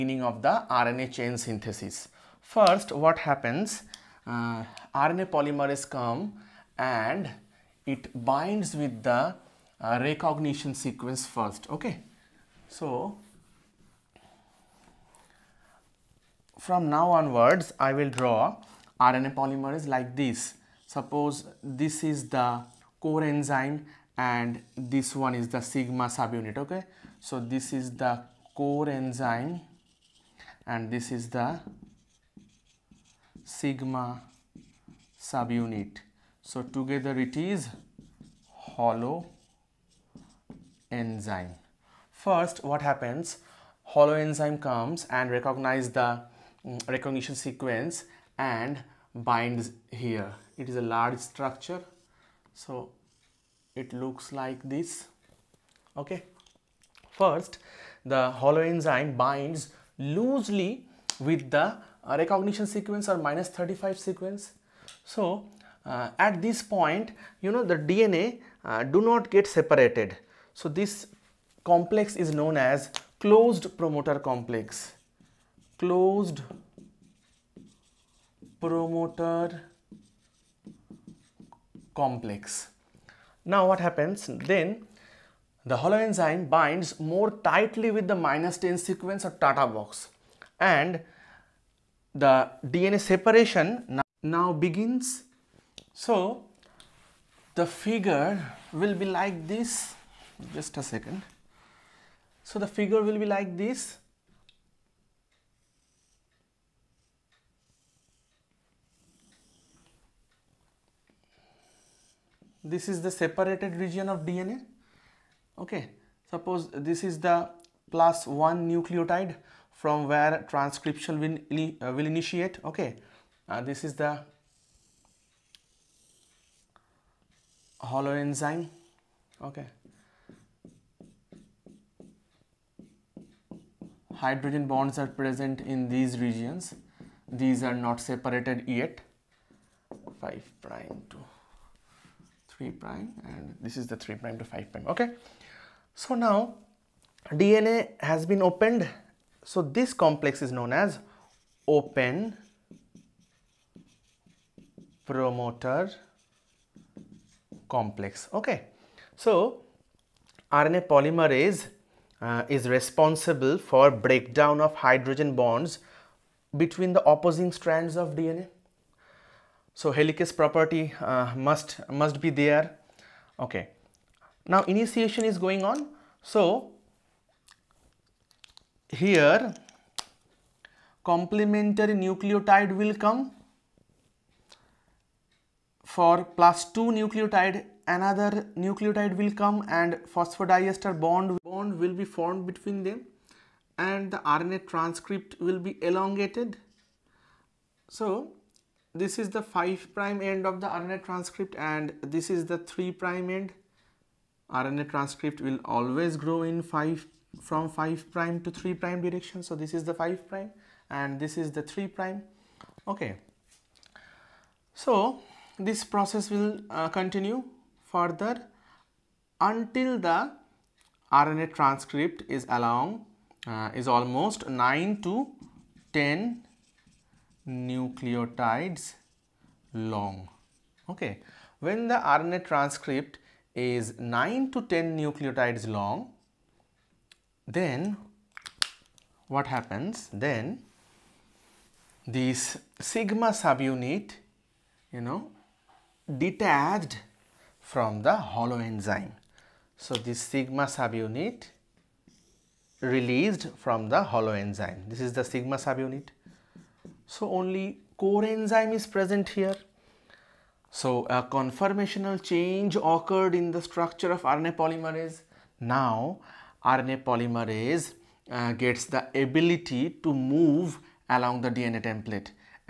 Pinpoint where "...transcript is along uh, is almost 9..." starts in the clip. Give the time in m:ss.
3:41.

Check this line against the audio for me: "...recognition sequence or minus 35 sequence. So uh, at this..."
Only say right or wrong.
right.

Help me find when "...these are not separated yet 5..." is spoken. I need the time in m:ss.
2:17.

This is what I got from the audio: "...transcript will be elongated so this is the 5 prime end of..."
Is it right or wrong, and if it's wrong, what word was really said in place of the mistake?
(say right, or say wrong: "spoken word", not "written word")
right.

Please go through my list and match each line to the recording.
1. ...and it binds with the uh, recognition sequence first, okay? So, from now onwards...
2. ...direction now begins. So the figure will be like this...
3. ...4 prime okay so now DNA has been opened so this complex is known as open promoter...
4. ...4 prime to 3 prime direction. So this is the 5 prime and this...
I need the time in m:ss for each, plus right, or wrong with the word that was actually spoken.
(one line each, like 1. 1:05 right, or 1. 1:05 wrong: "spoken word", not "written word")
1. 0:06 right
2. 1:32 wrong: "separation", not "direction"
3. 2:24 wrong: "5", not "4"
4. 3:27 wrong: "5", not "4".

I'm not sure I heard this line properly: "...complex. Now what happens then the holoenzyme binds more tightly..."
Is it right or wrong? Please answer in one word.
right.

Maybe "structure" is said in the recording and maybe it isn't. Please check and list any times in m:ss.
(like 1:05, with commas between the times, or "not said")
0:51, 4:23.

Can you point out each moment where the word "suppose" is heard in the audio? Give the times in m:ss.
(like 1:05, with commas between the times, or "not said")
0:20, 1:56.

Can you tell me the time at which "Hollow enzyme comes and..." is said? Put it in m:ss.
0:43.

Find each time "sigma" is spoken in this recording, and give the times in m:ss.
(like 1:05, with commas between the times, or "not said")
0:25, 0:33, 4:02, 4:10, 4:15.